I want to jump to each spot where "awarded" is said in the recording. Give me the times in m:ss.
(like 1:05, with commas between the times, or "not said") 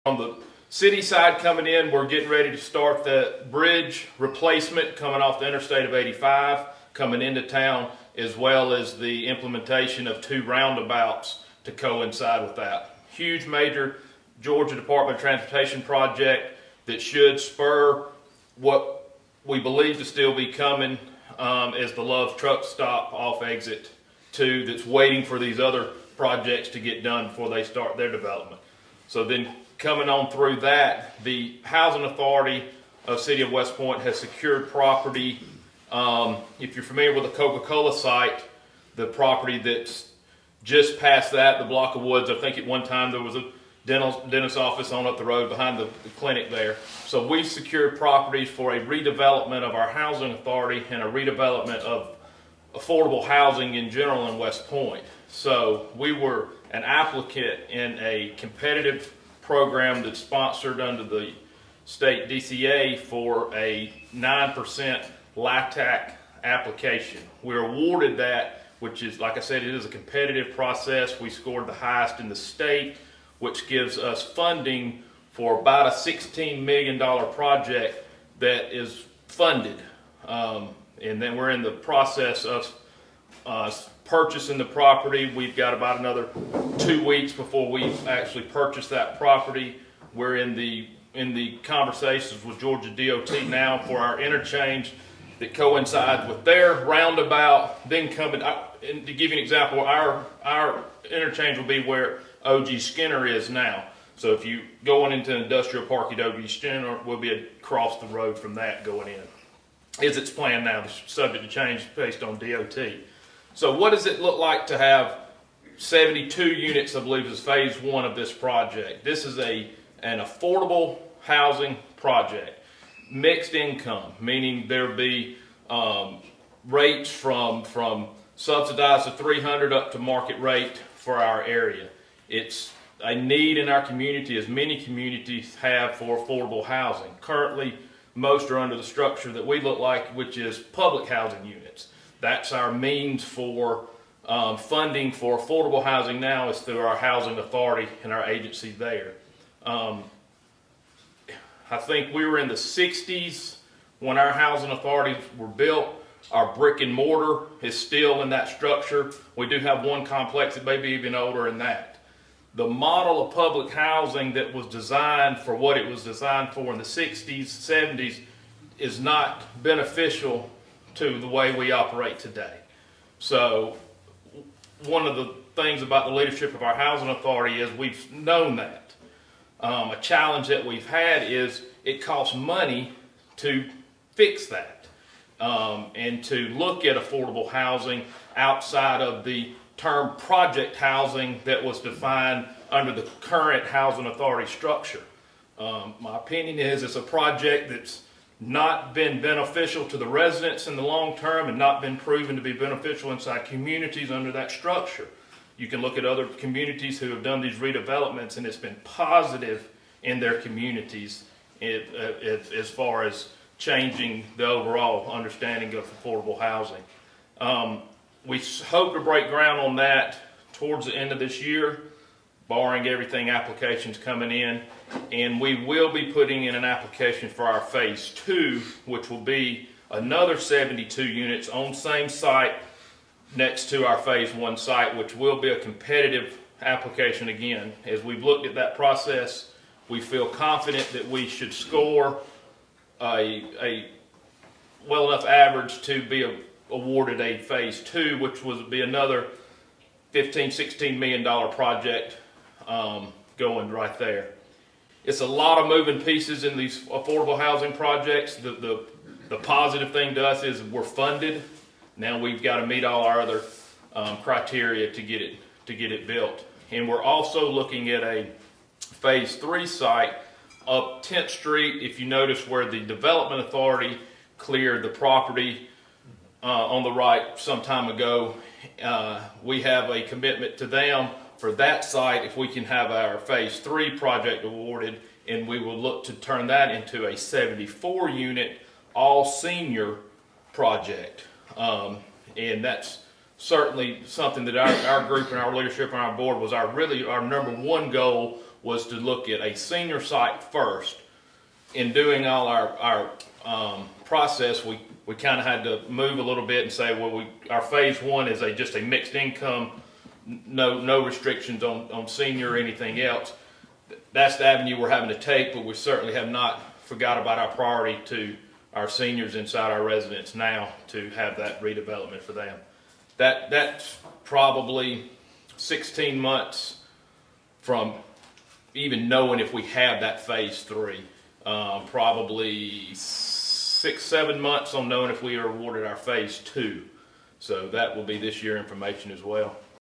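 1:07, 4:06, 4:44, 5:35.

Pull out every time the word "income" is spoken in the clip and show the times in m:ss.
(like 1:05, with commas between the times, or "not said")
2:03, 5:09.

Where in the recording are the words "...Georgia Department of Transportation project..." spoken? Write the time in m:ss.
0:14.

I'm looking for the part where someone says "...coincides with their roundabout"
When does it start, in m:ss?
1:35.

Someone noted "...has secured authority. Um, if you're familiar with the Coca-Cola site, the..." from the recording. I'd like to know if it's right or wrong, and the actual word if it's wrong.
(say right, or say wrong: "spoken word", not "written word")
wrong: "property", not "authority".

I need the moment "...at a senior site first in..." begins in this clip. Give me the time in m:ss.
4:59.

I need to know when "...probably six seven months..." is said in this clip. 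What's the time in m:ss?
5:31.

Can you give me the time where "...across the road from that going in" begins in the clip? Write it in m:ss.
1:47.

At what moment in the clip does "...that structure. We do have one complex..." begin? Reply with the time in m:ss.
2:38.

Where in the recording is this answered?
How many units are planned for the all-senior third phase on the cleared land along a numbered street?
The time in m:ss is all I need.
4:47.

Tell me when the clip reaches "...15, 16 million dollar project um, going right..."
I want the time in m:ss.
4:10.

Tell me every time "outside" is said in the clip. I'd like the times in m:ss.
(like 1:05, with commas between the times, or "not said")
3:08.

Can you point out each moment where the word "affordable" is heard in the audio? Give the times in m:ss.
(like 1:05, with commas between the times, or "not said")
0:52, 2:00, 2:16, 2:25, 3:06, 3:36, 4:16.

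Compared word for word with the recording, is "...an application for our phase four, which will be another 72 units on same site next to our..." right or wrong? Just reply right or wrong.
wrong.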